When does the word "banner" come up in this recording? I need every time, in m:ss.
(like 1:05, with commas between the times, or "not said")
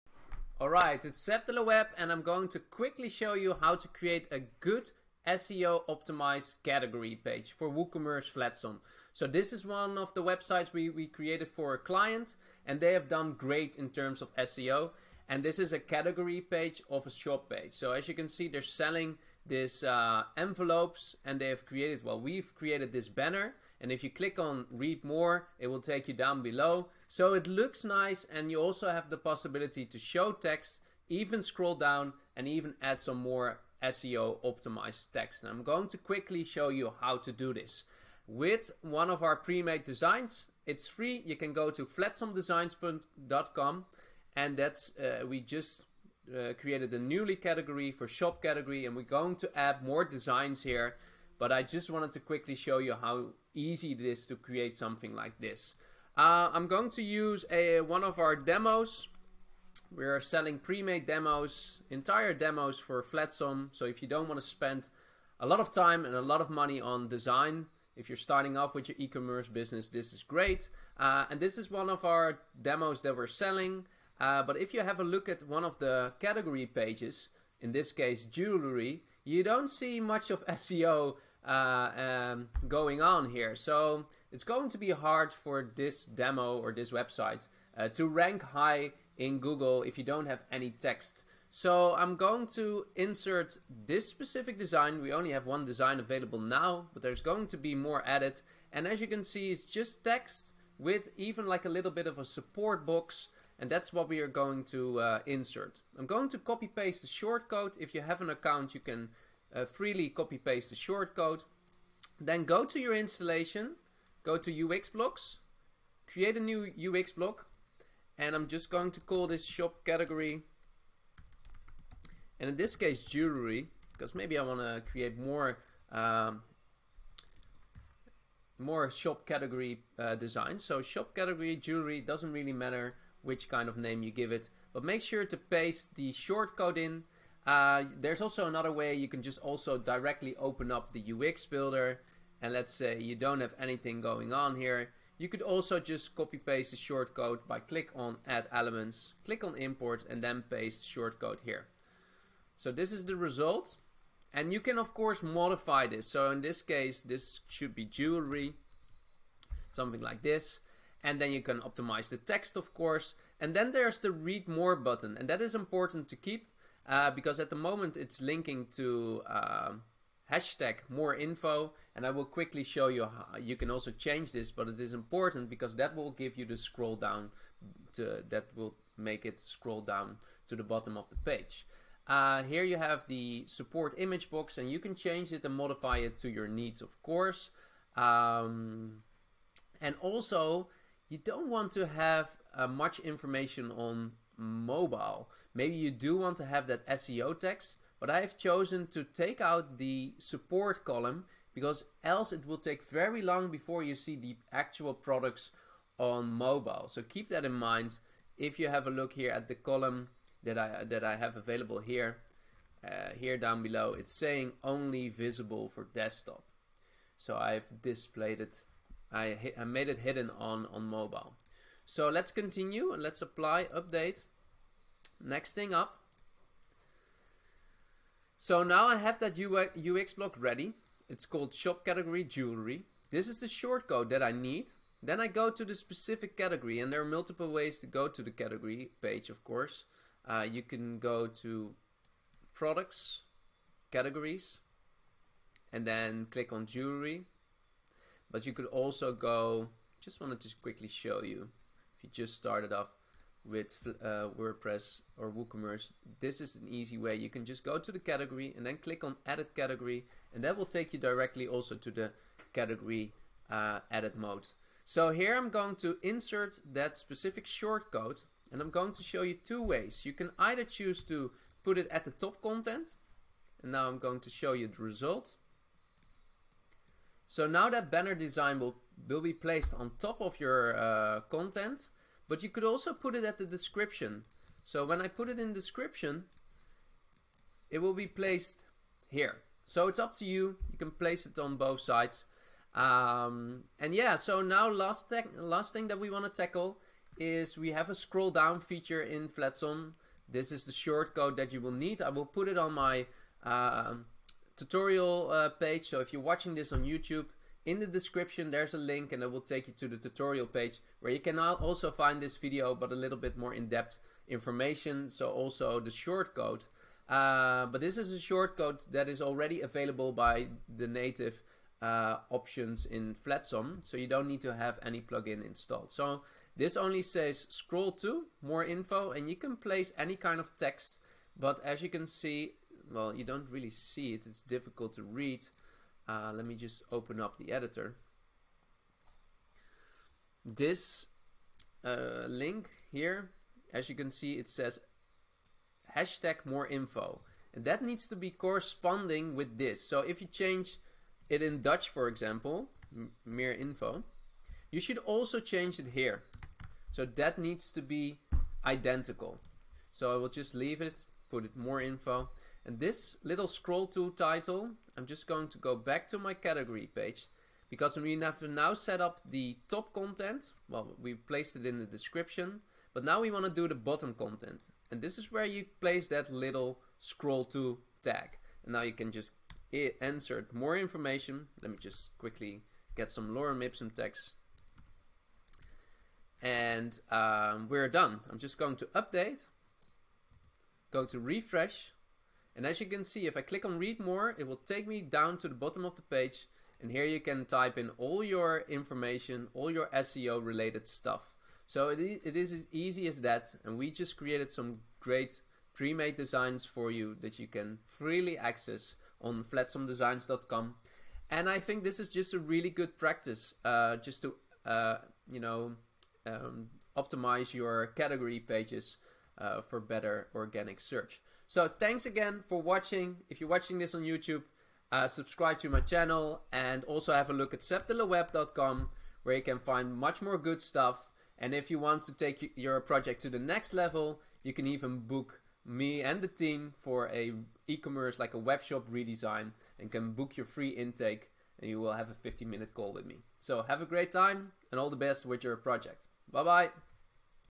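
0:23, 4:37.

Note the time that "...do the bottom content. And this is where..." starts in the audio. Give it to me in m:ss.
6:13.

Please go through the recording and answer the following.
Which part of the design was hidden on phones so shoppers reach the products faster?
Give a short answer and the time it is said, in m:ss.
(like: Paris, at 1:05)
The support column, at 3:20.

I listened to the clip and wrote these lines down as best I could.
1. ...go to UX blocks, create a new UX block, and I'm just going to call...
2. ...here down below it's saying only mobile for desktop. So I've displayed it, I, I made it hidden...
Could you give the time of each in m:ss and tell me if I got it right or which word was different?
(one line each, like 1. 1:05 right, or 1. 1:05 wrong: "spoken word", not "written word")
1. 1:54 right
2. 3:33 wrong: "visible", not "mobile".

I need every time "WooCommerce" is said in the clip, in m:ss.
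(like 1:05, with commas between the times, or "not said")
0:07, 4:15.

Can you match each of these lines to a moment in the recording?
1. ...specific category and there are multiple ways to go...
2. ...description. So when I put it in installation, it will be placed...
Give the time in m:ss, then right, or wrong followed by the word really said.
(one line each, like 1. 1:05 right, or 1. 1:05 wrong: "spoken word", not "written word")
1. 3:55 right
2. 4:43 wrong: "description", not "installation".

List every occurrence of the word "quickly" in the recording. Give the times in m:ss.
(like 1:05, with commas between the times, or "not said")
0:02, 0:35, 0:52, 2:52, 4:10, 6:22.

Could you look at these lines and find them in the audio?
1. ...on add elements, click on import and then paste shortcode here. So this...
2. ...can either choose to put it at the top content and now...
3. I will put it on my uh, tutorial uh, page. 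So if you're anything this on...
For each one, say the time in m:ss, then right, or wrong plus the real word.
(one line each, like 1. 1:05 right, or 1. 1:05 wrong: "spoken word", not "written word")
1. 2:27 right
2. 4:30 right
3. 5:02 wrong: "watching", not "anything".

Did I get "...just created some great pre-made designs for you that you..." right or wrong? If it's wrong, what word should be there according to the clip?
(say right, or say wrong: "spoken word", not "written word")
right.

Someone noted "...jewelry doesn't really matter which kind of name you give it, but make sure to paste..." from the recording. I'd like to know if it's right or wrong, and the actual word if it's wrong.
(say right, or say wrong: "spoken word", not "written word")
right.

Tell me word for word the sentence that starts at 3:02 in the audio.
Uh, here you have the support image box and you can change it and modify it to your needs of course.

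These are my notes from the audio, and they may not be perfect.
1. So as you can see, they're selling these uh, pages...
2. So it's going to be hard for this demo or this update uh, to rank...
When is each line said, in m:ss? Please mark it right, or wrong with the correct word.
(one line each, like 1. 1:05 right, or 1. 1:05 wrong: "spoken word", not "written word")
1. 0:17 wrong: "envelopes", not "pages"
2. 1:23 wrong: "website", not "update".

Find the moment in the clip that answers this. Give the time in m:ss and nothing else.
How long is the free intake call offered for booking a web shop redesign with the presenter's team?
7:22.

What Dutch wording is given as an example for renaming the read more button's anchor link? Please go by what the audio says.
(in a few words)
mere info.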